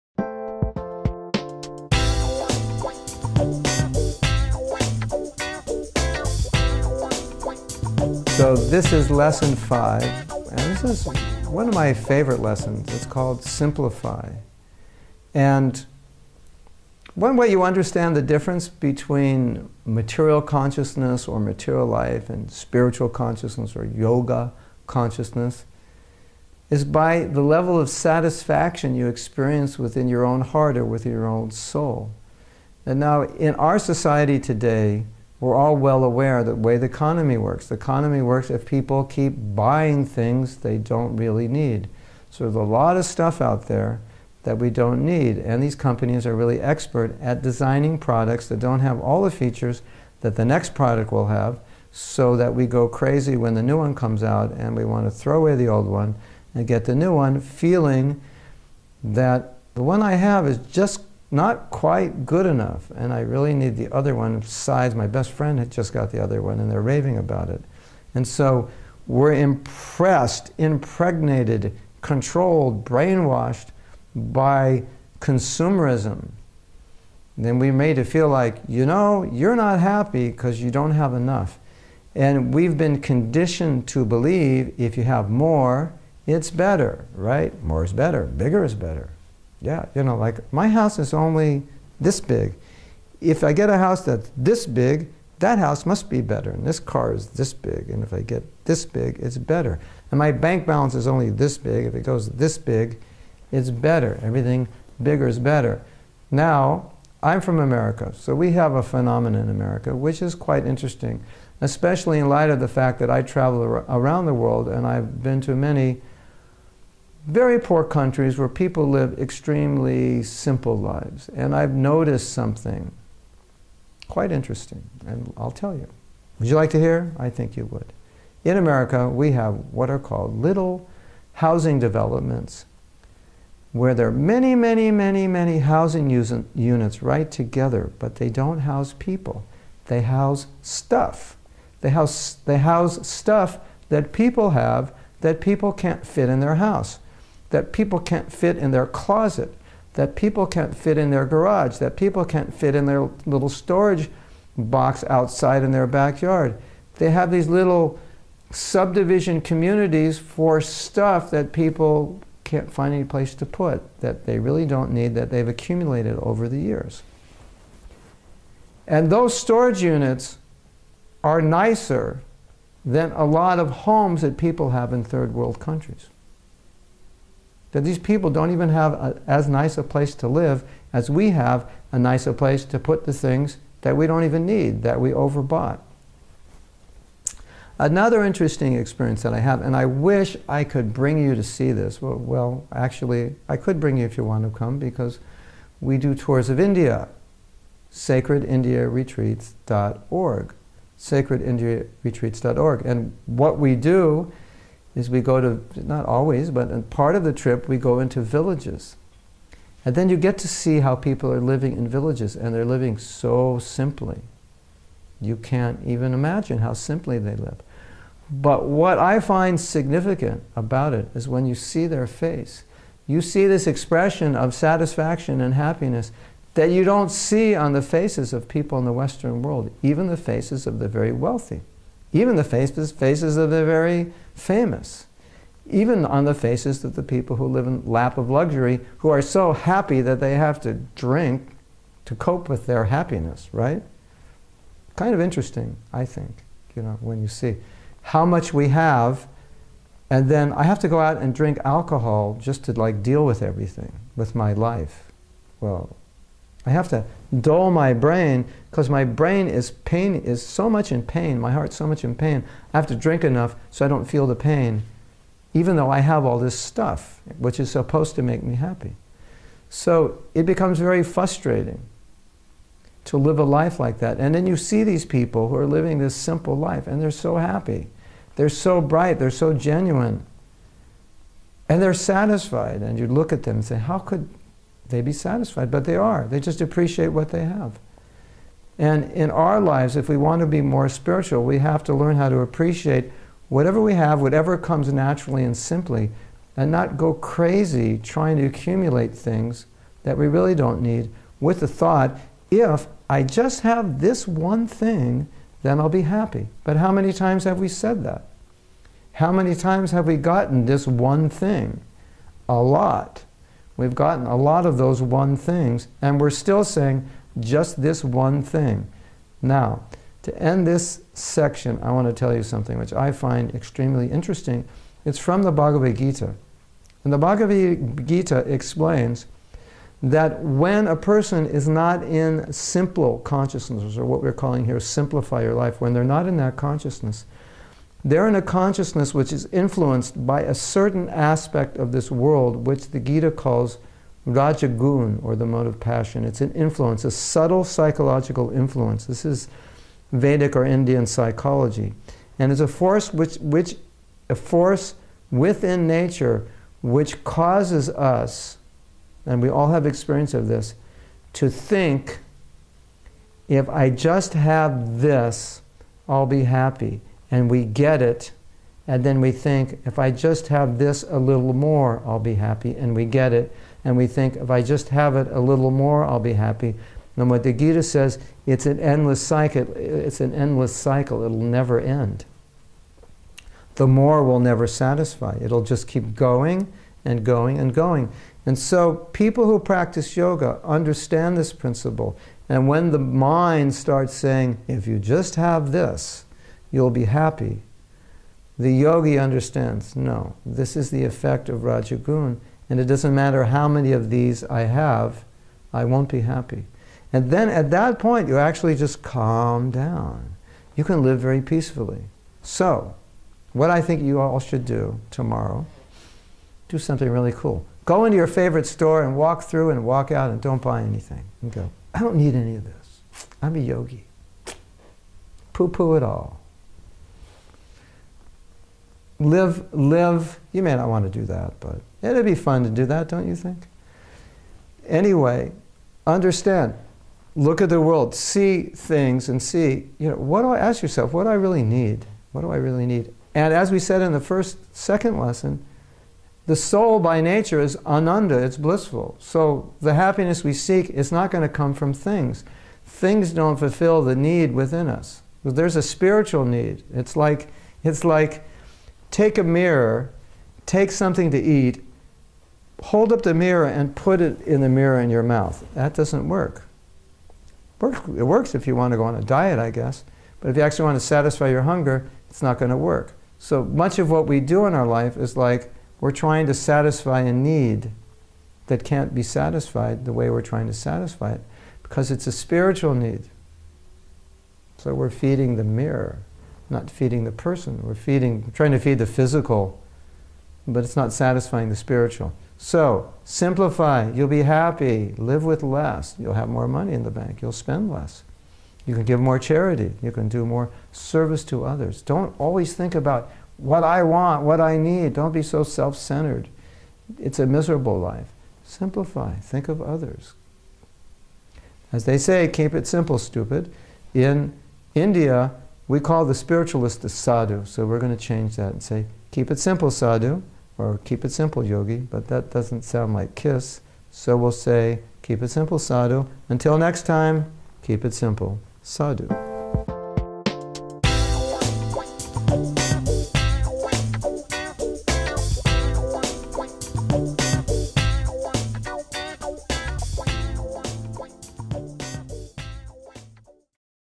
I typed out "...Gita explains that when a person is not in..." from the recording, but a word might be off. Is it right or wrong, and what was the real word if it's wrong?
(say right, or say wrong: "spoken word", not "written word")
right.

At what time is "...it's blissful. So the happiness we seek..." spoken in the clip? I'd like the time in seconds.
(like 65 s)
448 s.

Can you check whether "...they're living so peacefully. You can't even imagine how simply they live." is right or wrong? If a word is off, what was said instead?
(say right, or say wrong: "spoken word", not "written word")
wrong: "simply", not "peacefully".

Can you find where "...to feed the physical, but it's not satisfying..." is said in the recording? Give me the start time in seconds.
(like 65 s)
488 s.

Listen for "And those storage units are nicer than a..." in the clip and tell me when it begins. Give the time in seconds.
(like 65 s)
168 s.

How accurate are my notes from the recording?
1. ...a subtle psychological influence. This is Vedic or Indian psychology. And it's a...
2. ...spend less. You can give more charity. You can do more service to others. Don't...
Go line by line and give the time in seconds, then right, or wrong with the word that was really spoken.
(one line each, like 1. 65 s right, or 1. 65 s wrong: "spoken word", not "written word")
1. 347 s right
2. 497 s right.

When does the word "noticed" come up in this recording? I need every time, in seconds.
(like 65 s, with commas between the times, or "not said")
121 s.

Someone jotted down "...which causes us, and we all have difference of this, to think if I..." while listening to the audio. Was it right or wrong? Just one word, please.
wrong.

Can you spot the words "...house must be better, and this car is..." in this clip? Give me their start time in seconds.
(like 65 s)
95 s.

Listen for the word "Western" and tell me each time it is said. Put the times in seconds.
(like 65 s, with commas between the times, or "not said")
228 s.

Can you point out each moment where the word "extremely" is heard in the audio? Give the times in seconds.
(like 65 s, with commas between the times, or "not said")
119 s, 323 s.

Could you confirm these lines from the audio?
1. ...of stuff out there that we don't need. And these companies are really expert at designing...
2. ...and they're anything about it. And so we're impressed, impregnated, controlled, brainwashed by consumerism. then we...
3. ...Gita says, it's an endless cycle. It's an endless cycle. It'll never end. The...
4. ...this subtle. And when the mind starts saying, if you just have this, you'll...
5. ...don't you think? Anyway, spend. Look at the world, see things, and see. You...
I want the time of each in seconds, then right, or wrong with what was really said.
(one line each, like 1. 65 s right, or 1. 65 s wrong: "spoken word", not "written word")
1. 42 s right
2. 66 s wrong: "raving", not "anything"
3. 377 s right
4. 391 s wrong: "principle", not "subtle"
5. 433 s wrong: "understand", not "spend".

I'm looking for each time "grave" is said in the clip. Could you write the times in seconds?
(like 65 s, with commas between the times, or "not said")
not said.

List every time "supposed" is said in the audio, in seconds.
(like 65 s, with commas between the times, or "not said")
267 s.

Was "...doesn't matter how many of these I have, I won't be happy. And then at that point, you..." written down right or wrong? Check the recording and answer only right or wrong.
right.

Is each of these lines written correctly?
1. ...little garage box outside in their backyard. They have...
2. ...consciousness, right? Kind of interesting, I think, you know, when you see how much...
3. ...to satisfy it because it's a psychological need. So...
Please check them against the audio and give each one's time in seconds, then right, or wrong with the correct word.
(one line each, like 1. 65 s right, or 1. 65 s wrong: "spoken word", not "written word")
1. 153 s wrong: "storage", not "garage"
2. 242 s wrong: "happiness", not "consciousness"
3. 480 s wrong: "spiritual", not "psychological".